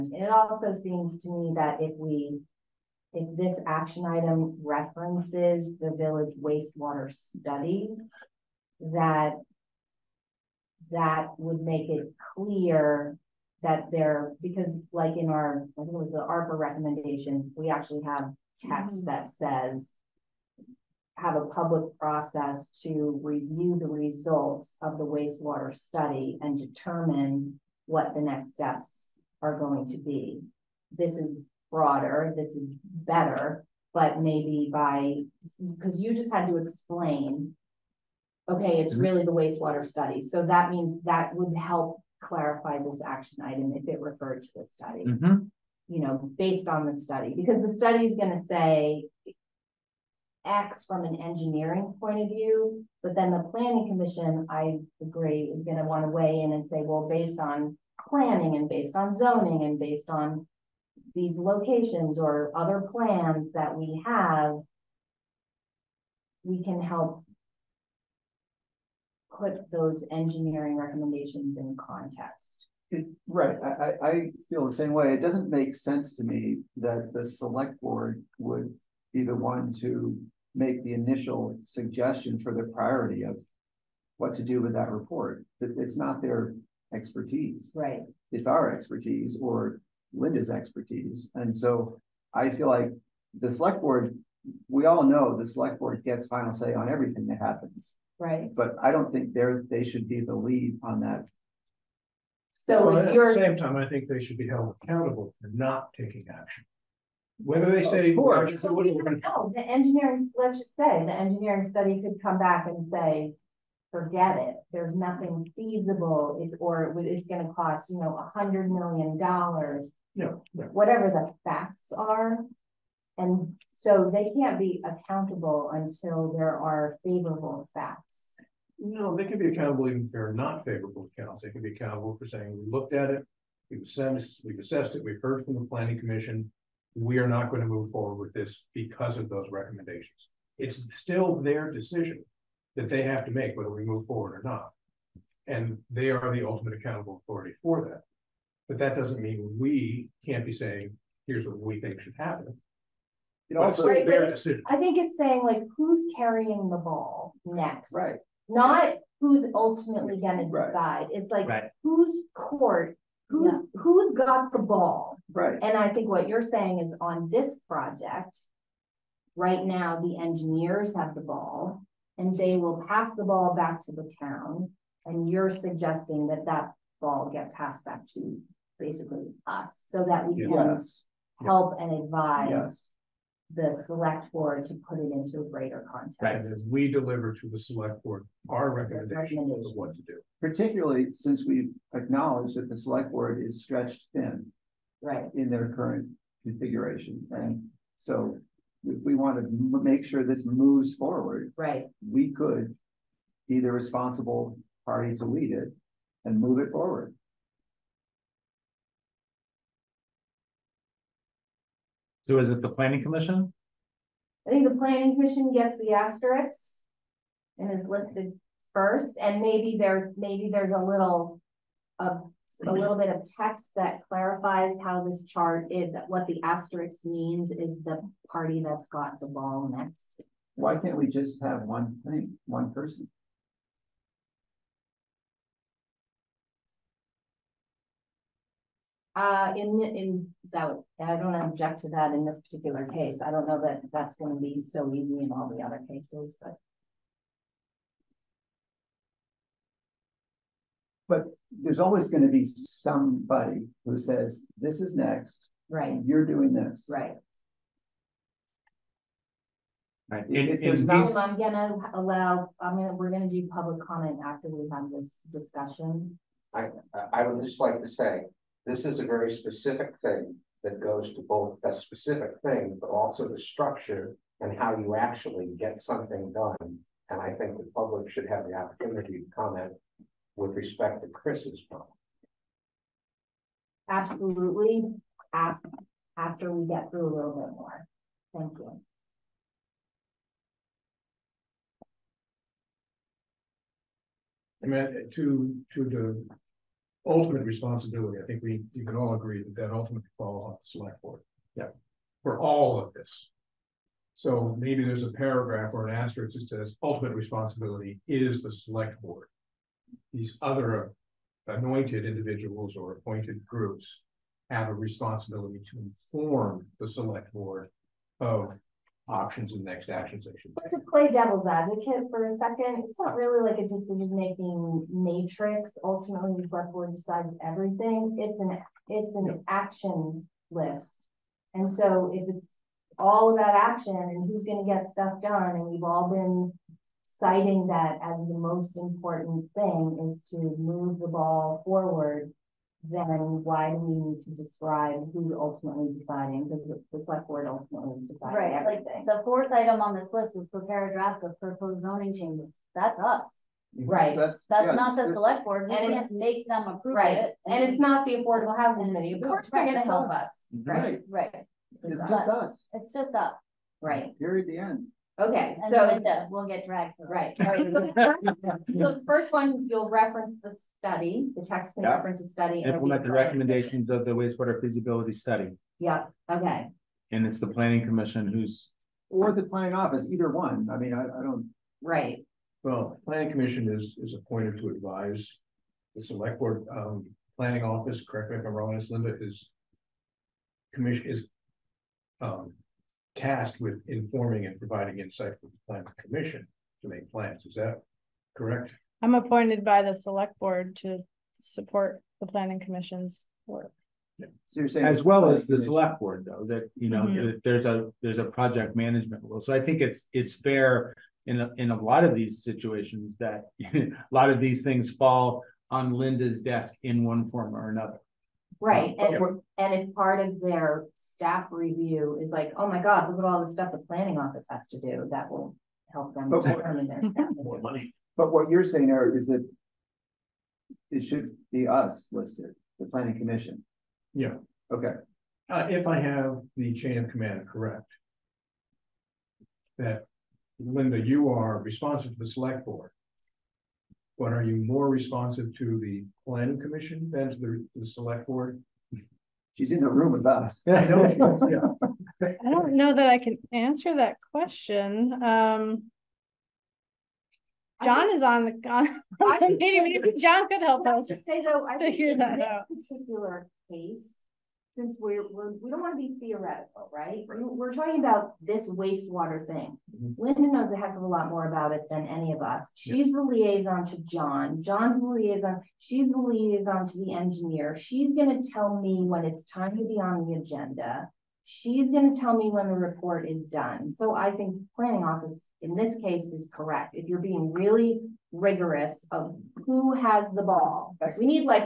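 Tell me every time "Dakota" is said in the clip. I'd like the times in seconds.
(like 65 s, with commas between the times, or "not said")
not said.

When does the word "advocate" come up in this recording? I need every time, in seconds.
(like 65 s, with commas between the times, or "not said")
321 s.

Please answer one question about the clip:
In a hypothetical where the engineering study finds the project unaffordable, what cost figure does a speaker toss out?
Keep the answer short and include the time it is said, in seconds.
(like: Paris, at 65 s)
a hundred million dollars, at 118 s.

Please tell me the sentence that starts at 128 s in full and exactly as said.
No, they can be accountable even if they're not favorable accounts.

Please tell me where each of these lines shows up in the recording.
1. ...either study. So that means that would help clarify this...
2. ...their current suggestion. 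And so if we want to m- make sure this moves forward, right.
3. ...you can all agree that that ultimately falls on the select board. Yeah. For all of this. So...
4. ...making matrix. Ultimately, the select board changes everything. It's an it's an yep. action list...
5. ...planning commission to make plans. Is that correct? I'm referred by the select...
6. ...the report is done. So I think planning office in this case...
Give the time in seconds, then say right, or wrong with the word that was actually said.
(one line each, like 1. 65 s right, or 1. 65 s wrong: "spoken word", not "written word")
1. 39 s wrong: "wastewater", not "either"
2. 195 s wrong: "configuration", not "suggestion"
3. 298 s right
4. 324 s wrong: "decides", not "changes"
5. 395 s wrong: "appointed", not "referred"
6. 482 s right.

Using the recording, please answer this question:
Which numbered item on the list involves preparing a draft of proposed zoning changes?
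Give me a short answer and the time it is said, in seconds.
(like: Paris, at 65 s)
fourth, at 349 s.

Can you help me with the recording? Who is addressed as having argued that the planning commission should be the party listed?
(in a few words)
Eric.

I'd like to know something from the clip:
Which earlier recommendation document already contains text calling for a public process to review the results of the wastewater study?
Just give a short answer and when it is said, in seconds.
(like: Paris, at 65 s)
ARPA recommendation, at 16 s.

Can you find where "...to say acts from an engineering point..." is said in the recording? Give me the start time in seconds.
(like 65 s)
48 s.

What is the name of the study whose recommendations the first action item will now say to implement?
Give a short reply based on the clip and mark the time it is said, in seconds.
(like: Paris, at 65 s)
wastewater feasibility study, at 374 s.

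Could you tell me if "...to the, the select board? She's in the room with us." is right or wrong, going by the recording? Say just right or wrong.
right.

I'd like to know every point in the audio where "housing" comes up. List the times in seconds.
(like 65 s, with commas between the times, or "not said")
358 s.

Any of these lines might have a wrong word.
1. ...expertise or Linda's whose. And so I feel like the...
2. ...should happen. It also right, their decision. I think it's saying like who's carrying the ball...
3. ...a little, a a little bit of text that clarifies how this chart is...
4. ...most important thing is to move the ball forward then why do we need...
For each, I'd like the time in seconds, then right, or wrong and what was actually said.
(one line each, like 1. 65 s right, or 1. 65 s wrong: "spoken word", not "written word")
1. 88 s wrong: "expertise", not "whose"
2. 152 s right
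3. 220 s right
4. 338 s right.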